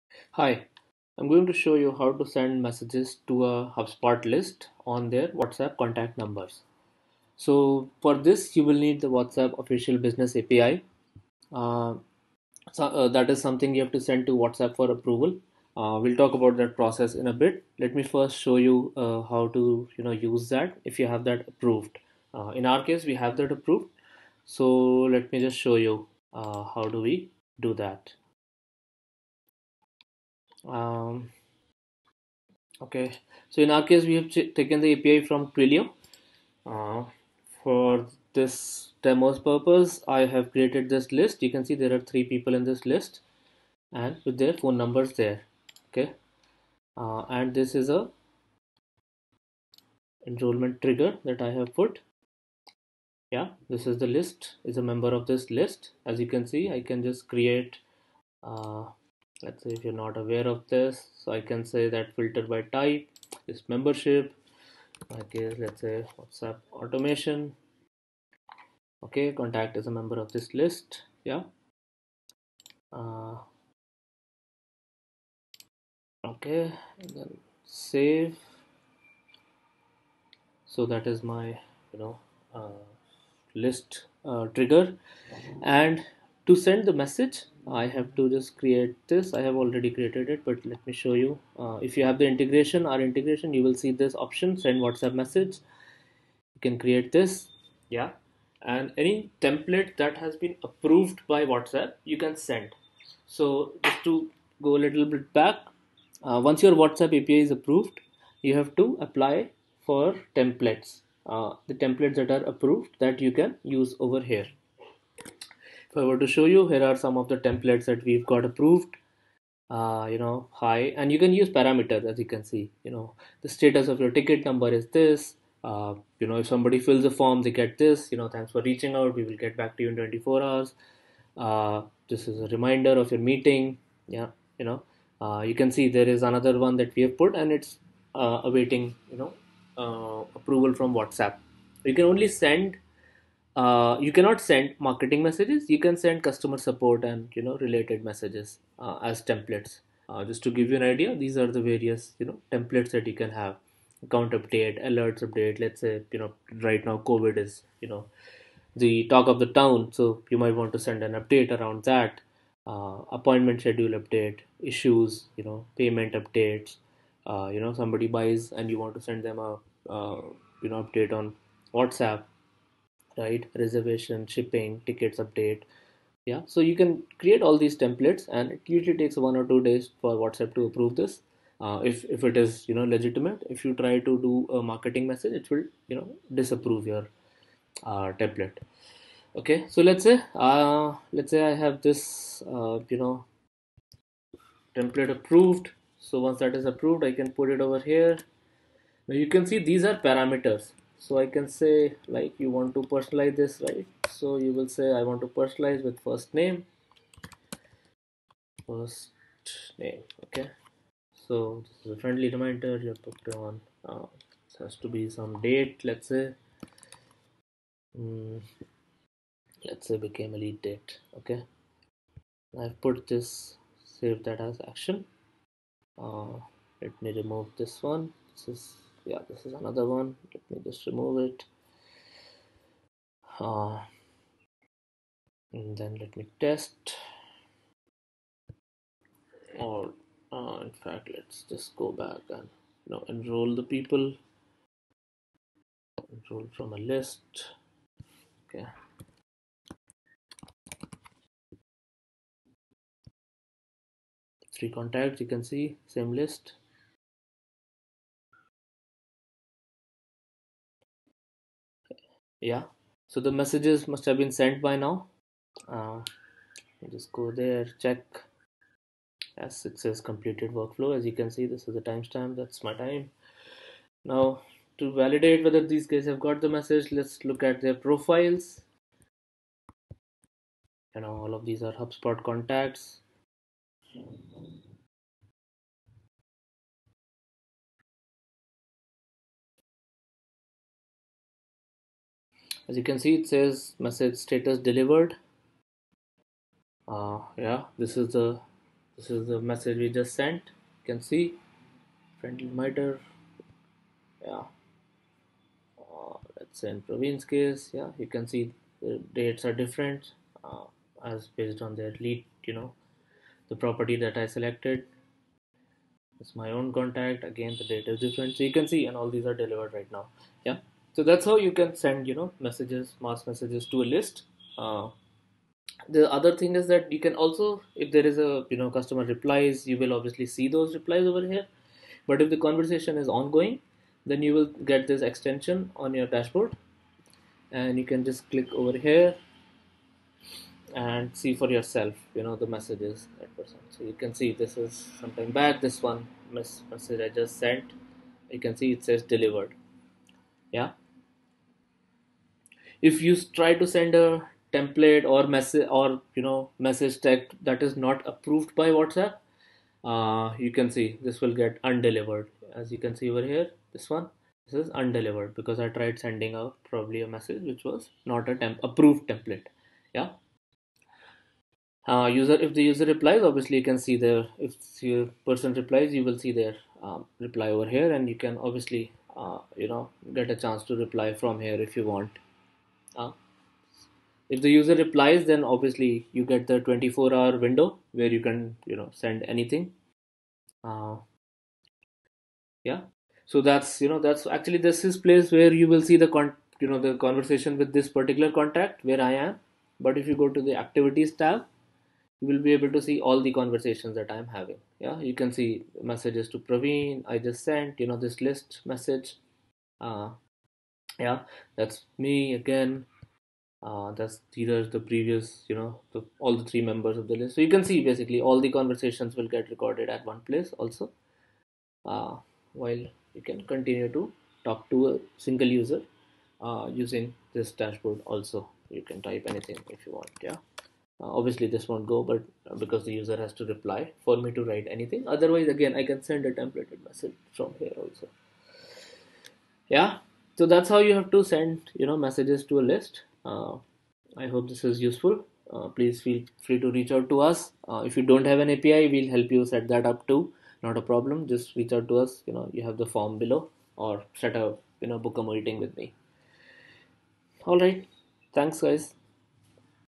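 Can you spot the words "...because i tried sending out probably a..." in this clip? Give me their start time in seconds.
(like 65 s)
365 s.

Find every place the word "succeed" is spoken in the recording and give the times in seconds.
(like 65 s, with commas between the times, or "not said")
not said.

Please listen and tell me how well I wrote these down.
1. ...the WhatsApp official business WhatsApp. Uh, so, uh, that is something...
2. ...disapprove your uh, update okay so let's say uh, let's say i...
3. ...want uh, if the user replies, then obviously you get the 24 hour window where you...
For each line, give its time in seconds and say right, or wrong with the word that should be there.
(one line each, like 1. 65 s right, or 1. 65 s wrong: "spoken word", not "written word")
1. 9 s wrong: "API", not "WhatsApp"
2. 186 s wrong: "template", not "update"
3. 381 s right.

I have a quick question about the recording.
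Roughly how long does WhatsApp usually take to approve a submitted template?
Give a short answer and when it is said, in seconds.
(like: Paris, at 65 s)
one or two days, at 179 s.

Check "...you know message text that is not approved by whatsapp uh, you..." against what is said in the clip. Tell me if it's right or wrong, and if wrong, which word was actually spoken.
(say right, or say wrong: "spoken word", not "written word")
right.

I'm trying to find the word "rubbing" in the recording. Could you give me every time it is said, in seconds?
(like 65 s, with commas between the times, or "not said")
not said.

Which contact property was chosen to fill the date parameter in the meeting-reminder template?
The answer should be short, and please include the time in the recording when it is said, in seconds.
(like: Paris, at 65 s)
Became a lead date, at 219 s.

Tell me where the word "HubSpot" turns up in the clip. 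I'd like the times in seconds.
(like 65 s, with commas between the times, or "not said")
3 s, 281 s.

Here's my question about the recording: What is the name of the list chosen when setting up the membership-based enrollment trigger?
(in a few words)
WhatsApp automation.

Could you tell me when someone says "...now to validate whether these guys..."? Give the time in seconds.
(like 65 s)
274 s.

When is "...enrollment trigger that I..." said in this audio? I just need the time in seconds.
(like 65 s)
50 s.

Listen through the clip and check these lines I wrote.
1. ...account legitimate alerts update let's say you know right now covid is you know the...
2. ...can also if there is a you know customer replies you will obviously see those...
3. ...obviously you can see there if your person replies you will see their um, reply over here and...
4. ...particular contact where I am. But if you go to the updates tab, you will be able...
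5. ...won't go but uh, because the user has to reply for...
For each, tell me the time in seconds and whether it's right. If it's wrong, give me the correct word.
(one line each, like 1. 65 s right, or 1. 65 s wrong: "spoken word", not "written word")
1. 154 s wrong: "update", not "legitimate"
2. 326 s right
3. 373 s right
4. 397 s wrong: "activities", not "updates"
5. 431 s right.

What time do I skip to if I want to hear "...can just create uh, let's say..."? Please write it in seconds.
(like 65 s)
56 s.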